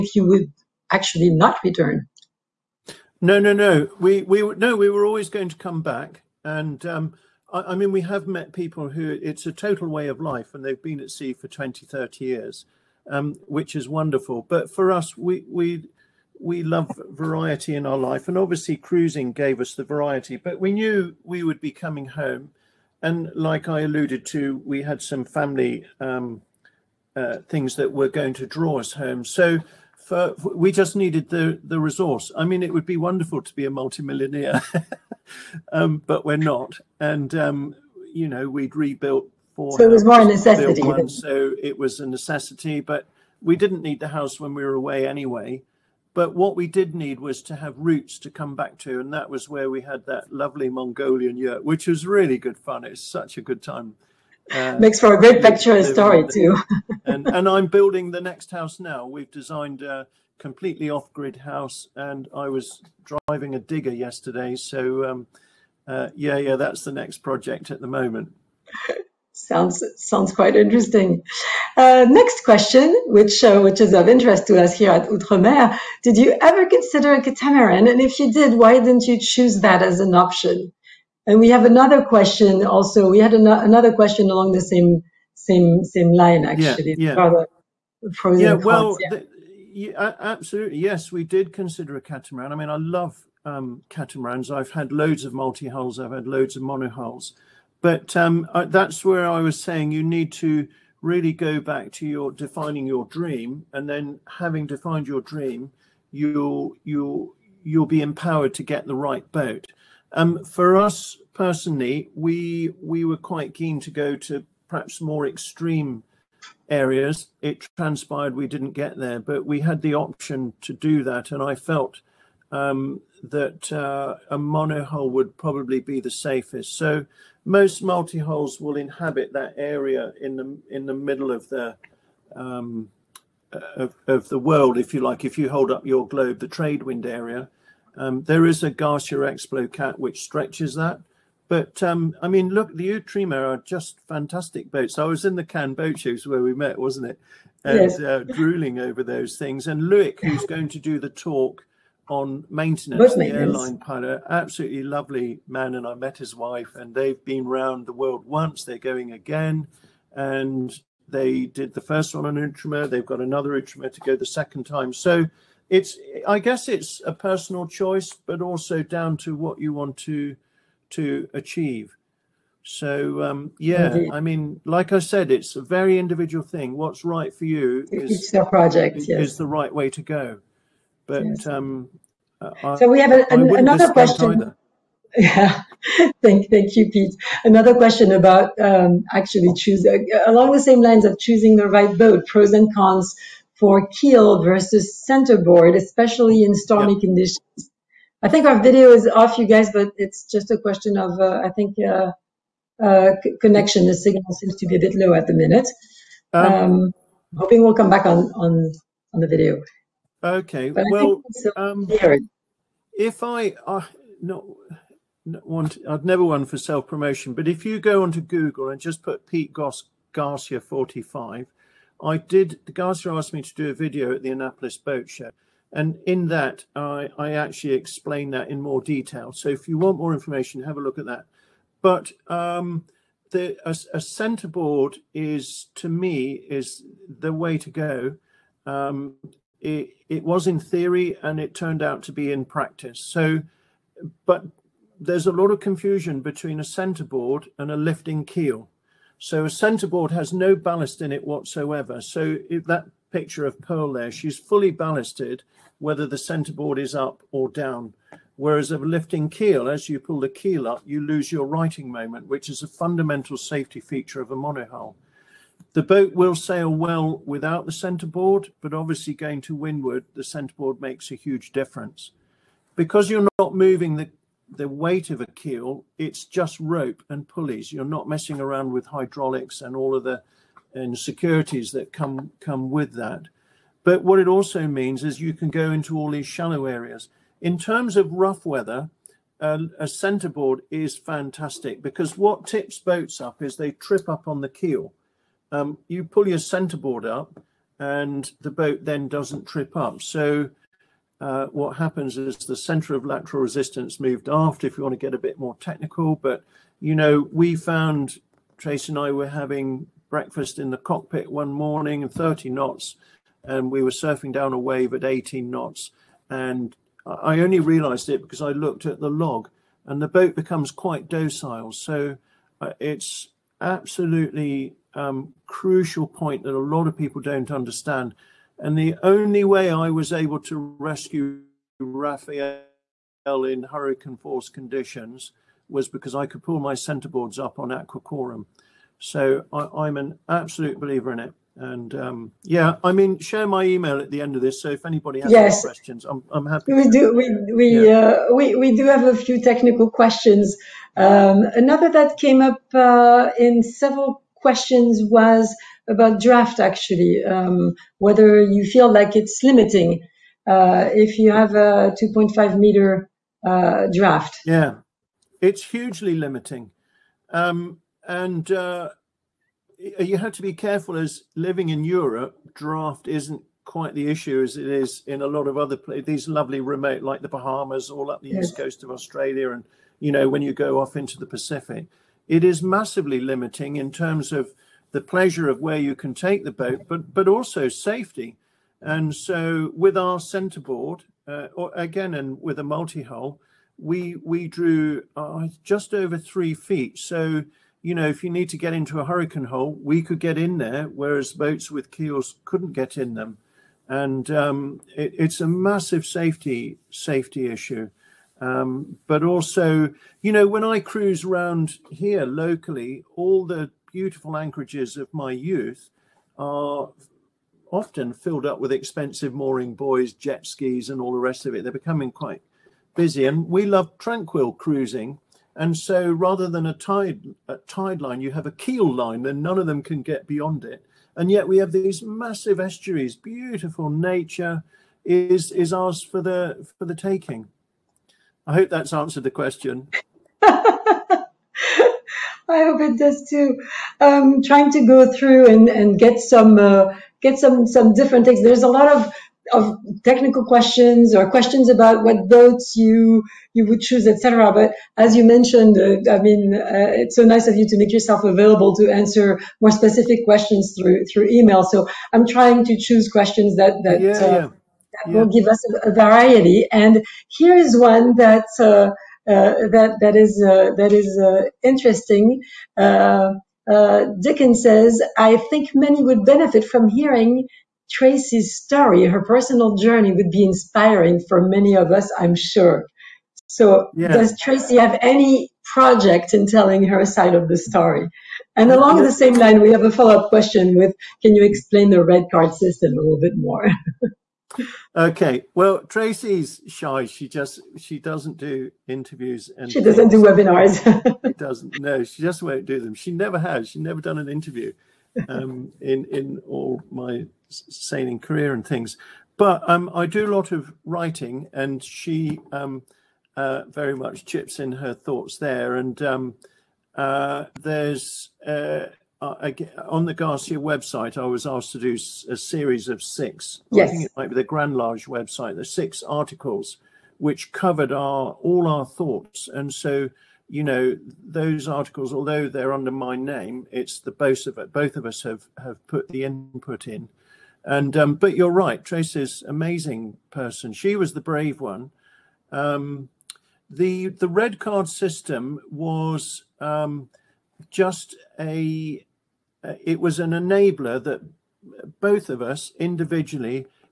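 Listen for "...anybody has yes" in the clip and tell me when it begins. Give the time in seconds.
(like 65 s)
344 s.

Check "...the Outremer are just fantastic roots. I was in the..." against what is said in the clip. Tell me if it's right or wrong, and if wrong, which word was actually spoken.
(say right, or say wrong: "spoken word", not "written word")
wrong: "boats", not "roots".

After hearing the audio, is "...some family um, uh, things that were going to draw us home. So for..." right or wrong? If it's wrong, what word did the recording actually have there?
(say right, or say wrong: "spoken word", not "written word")
right.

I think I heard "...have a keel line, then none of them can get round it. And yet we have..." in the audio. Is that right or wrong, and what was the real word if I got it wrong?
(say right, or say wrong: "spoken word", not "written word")
wrong: "beyond", not "round".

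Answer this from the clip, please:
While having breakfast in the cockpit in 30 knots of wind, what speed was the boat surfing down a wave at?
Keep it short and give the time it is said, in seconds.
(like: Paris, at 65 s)
18 knots, at 315 s.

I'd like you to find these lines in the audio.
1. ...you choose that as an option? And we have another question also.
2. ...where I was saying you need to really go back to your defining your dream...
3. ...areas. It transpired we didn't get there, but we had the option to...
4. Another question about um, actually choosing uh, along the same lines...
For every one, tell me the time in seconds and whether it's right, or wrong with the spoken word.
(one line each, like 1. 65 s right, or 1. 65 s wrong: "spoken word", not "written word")
1. 79 s right
2. 99 s right
3. 116 s right
4. 187 s right.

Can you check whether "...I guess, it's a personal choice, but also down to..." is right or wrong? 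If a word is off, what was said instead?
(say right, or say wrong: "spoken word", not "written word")
right.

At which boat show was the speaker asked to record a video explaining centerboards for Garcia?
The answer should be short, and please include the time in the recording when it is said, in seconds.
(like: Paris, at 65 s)
Annapolis, at 224 s.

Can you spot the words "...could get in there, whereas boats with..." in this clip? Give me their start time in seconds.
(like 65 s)
400 s.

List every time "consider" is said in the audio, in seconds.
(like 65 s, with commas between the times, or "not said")
76 s, 91 s.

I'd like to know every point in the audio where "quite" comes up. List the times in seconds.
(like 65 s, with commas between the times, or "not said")
70 s, 113 s, 320 s, 373 s, 422 s.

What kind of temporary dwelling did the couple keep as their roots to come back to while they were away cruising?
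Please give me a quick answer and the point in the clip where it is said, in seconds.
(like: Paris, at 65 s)
Mongolian yurt, at 50 s.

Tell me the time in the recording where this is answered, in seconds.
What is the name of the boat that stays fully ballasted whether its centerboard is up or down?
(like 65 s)
253 s.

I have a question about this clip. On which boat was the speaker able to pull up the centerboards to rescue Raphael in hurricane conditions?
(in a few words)
Aqua Quorum.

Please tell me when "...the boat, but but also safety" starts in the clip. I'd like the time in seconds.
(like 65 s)
386 s.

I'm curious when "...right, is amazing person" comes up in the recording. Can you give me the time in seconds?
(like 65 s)
538 s.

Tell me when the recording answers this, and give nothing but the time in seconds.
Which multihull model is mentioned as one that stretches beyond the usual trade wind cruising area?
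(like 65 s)
138 s.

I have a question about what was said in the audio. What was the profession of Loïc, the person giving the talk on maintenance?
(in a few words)
Airline pilot.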